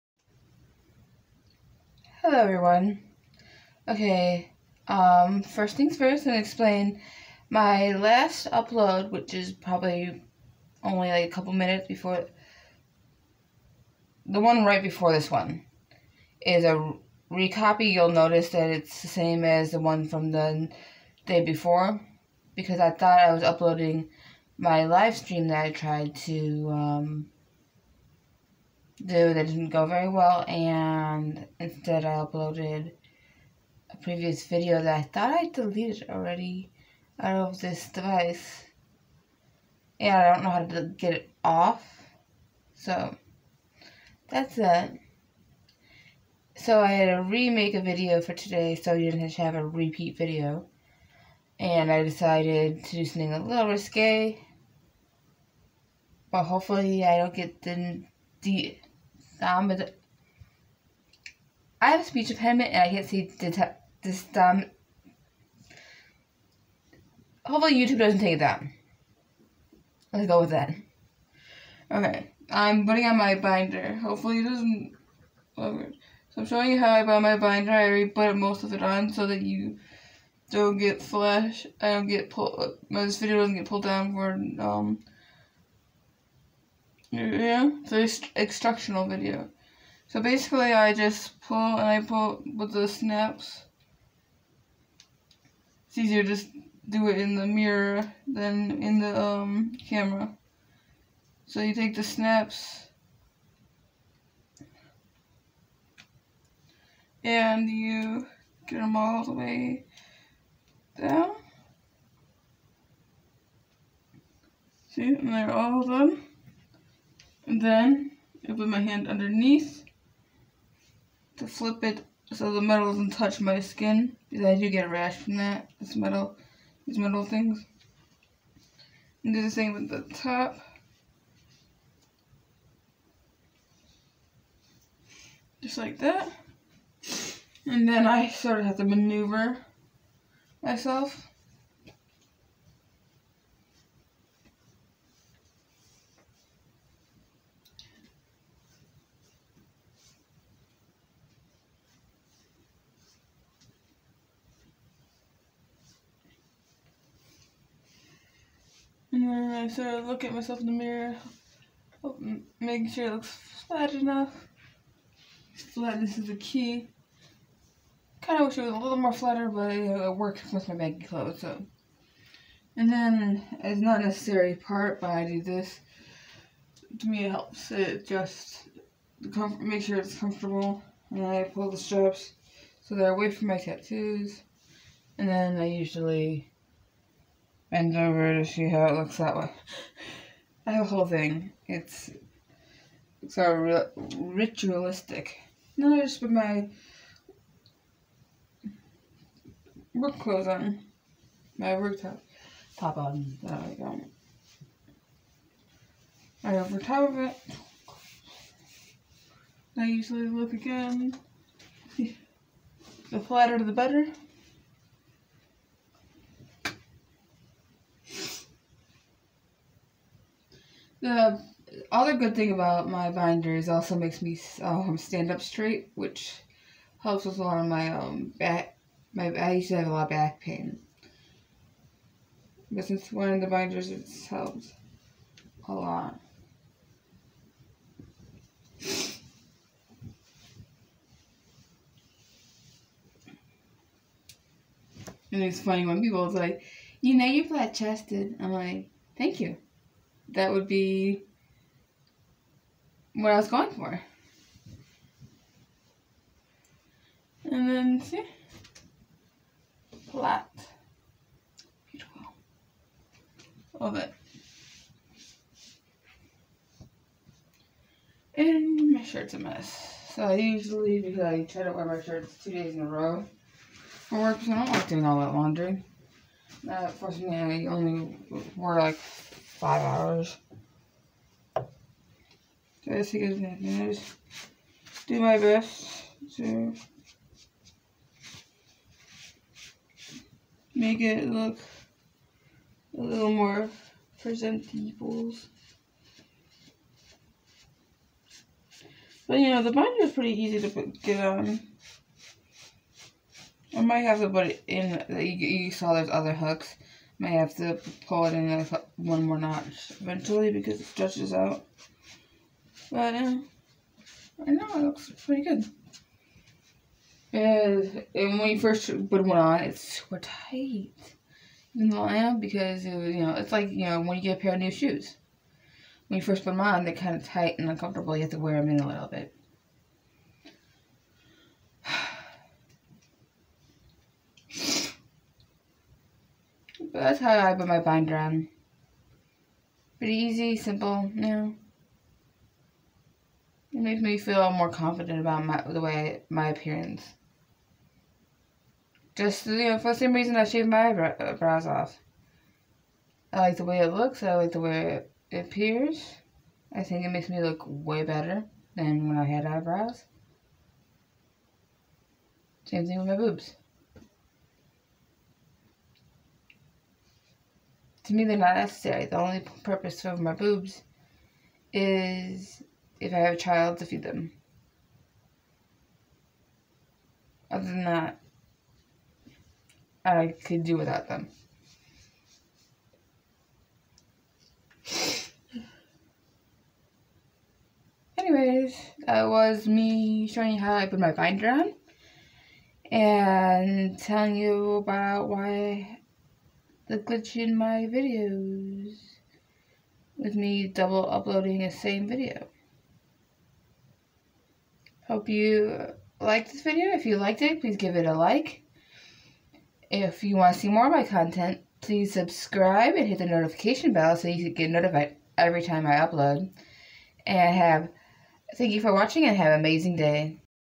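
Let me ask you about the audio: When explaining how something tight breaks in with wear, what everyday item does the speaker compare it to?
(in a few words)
new shoes.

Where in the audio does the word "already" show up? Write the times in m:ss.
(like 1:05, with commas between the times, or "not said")
0:36, 1:17.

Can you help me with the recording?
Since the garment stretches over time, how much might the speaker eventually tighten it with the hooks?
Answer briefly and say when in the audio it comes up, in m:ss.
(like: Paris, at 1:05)
one more notch, at 5:08.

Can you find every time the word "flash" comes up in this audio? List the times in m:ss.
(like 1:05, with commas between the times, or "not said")
1:21.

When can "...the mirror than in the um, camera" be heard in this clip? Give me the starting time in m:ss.
1:37.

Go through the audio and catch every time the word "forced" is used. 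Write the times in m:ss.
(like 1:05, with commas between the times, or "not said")
4:36.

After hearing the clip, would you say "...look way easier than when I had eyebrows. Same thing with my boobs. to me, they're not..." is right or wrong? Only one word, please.
wrong.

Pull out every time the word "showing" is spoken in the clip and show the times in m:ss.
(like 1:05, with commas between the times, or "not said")
1:16, 6:30.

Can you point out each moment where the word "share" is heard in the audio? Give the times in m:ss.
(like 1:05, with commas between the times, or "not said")
not said.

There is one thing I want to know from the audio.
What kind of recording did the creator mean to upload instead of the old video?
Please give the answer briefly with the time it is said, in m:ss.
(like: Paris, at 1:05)
live stream, at 0:24.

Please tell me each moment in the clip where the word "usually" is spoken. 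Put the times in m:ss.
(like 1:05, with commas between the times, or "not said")
3:05, 3:29, 4:30.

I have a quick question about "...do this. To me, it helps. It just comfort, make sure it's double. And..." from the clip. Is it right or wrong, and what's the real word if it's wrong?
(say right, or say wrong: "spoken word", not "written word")
wrong: "comfortable", not "double".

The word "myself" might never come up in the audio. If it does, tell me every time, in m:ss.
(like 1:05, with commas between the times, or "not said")
2:20, 2:40.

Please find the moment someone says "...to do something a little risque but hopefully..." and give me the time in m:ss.
0:52.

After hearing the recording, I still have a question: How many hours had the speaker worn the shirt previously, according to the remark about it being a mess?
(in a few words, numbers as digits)
5 hours.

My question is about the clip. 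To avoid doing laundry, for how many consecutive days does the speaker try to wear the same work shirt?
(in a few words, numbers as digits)
2 days.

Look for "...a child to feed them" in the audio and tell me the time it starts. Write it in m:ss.
6:13.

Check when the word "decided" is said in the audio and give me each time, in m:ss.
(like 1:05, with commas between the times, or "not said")
0:52.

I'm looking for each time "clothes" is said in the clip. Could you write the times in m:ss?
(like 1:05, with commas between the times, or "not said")
2:51, 3:20.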